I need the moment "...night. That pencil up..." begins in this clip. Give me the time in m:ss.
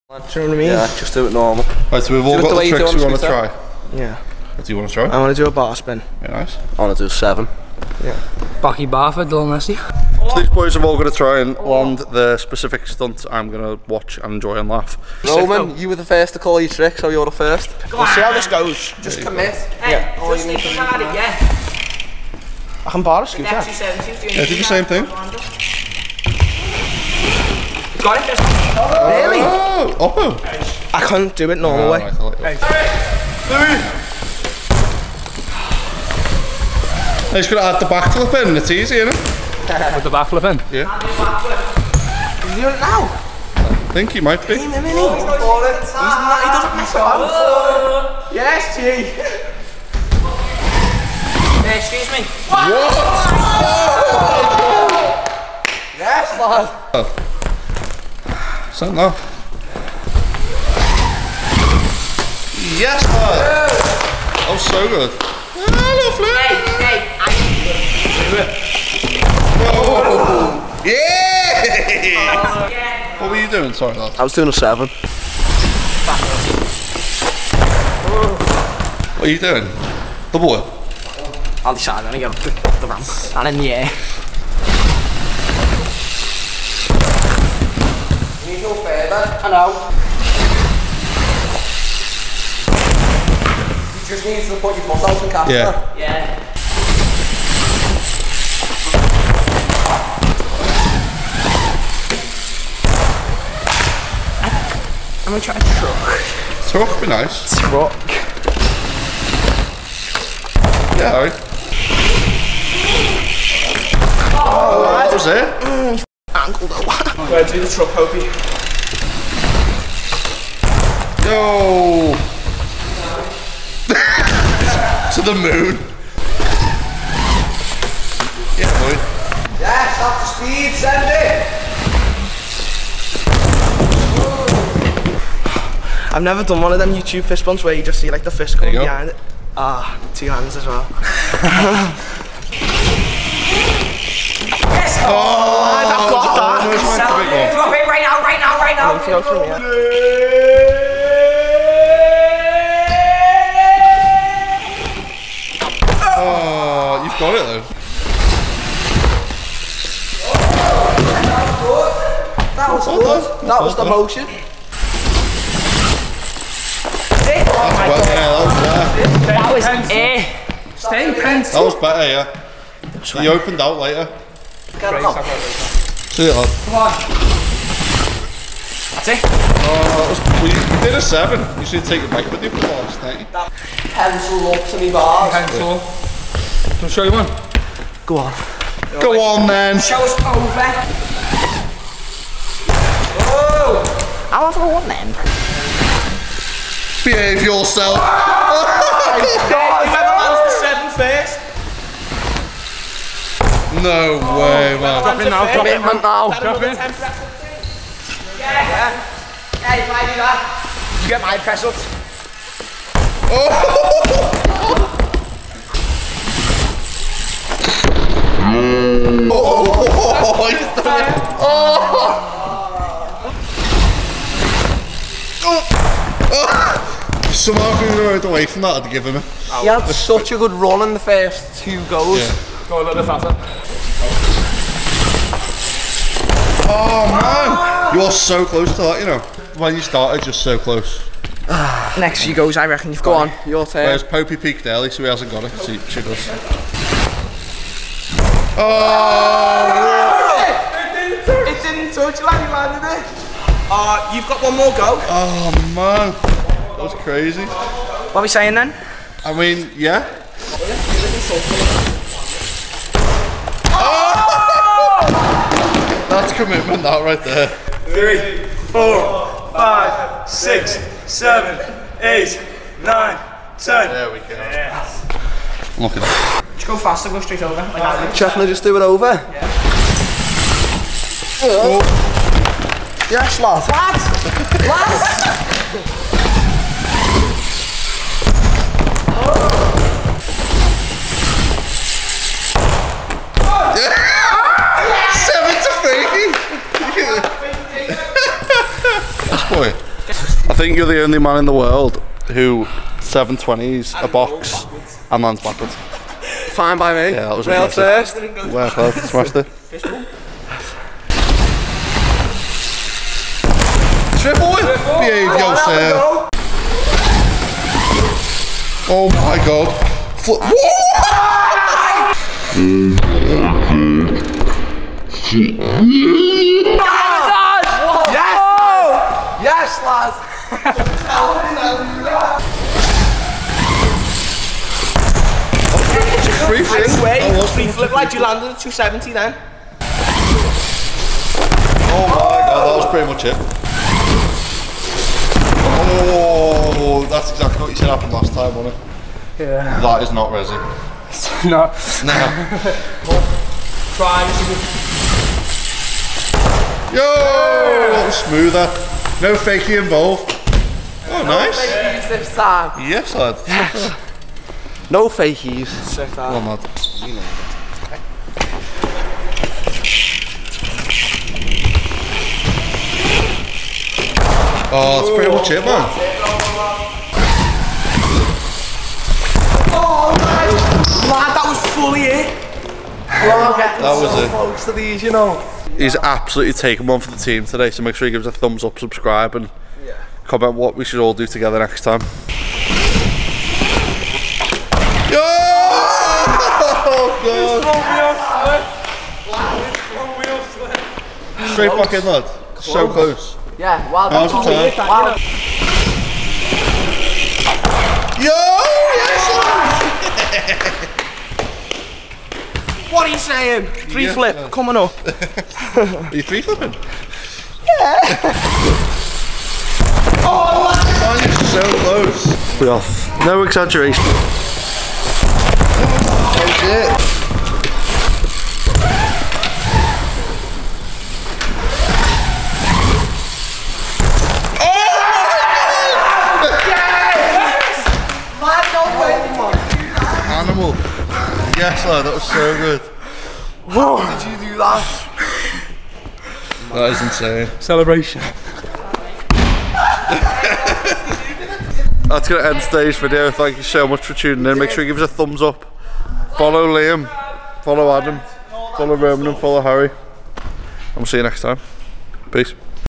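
3:03.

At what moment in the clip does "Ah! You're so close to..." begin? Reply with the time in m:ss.
3:57.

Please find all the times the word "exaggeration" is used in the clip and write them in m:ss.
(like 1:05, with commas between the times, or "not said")
7:03.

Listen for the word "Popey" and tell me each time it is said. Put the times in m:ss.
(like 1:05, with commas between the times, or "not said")
4:04.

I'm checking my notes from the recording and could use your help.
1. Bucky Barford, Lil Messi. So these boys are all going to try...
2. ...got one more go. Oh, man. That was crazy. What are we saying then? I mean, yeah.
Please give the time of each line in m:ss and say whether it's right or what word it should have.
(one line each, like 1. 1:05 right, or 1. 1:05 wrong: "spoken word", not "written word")
1. 0:08 right
2. 4:14 right.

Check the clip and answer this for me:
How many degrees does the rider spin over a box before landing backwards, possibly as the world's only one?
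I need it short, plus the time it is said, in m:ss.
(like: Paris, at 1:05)
720, at 5:02.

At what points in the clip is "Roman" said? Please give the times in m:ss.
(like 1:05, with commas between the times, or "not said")
0:15, 7:38.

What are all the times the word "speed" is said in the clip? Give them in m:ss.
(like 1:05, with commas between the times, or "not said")
2:10.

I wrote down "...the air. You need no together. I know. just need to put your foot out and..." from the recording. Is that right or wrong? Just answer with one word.
wrong.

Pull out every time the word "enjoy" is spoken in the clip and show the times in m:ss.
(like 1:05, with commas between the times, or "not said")
0:14.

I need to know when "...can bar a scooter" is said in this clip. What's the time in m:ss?
0:22.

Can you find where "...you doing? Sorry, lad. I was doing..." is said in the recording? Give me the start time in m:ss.
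1:13.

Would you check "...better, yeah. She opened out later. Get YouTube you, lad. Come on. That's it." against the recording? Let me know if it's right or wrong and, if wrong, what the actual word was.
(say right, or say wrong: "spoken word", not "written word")
wrong: "See", not "YouTube".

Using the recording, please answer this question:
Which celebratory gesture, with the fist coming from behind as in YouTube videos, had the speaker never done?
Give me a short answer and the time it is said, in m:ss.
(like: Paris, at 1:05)
fist bumps, at 2:16.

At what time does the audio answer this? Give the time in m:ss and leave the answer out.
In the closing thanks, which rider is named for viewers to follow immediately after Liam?
7:37.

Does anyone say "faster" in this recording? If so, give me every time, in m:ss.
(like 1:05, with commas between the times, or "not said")
3:53, 4:36.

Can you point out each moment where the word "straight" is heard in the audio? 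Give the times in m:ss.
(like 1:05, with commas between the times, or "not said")
4:37, 6:41.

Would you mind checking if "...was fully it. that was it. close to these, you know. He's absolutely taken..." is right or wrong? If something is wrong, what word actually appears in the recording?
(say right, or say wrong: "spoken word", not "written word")
right.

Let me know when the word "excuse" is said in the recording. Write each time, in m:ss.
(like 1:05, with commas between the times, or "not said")
0:51.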